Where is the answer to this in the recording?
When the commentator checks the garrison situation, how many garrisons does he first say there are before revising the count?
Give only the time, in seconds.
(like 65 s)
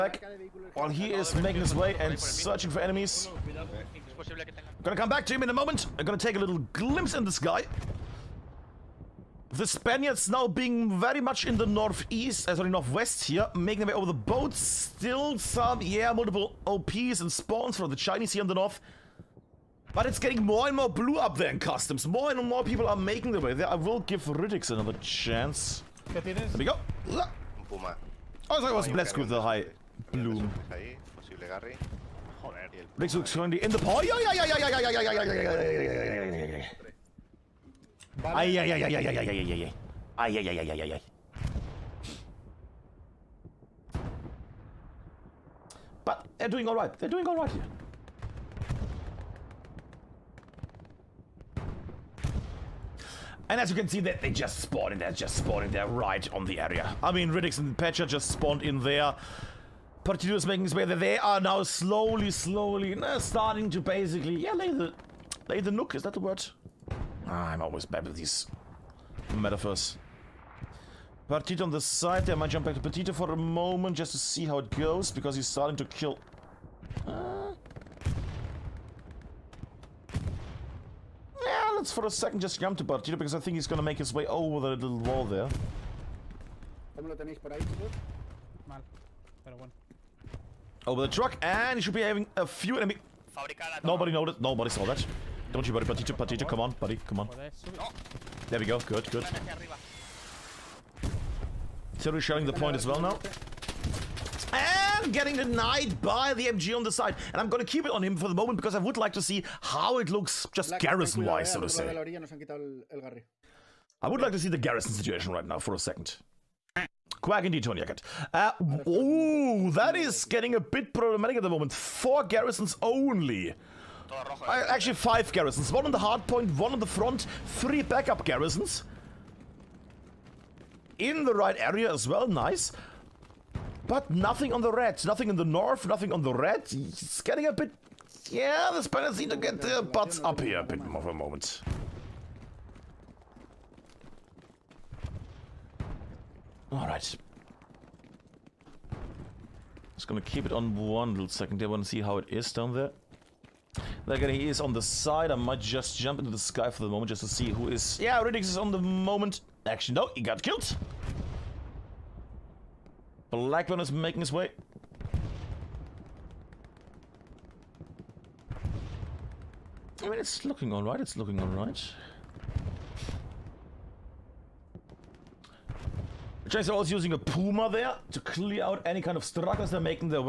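121 s.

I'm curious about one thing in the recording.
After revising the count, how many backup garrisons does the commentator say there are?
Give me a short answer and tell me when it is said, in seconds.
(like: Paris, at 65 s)
3, at 127 s.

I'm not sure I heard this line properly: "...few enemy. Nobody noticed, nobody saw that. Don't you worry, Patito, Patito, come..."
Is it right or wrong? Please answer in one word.
right.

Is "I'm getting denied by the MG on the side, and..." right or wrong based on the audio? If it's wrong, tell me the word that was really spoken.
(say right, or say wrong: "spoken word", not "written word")
right.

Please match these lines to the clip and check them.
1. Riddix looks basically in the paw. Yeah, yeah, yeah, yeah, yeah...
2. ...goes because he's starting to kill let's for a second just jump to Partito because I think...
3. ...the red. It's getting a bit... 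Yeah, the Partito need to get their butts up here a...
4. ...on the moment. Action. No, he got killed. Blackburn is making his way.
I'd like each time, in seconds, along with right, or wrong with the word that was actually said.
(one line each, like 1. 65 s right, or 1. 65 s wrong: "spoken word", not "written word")
1. 32 s wrong: "currently", not "basically"
2. 74 s right
3. 136 s wrong: "Spaniards", not "Partito"
4. 158 s right.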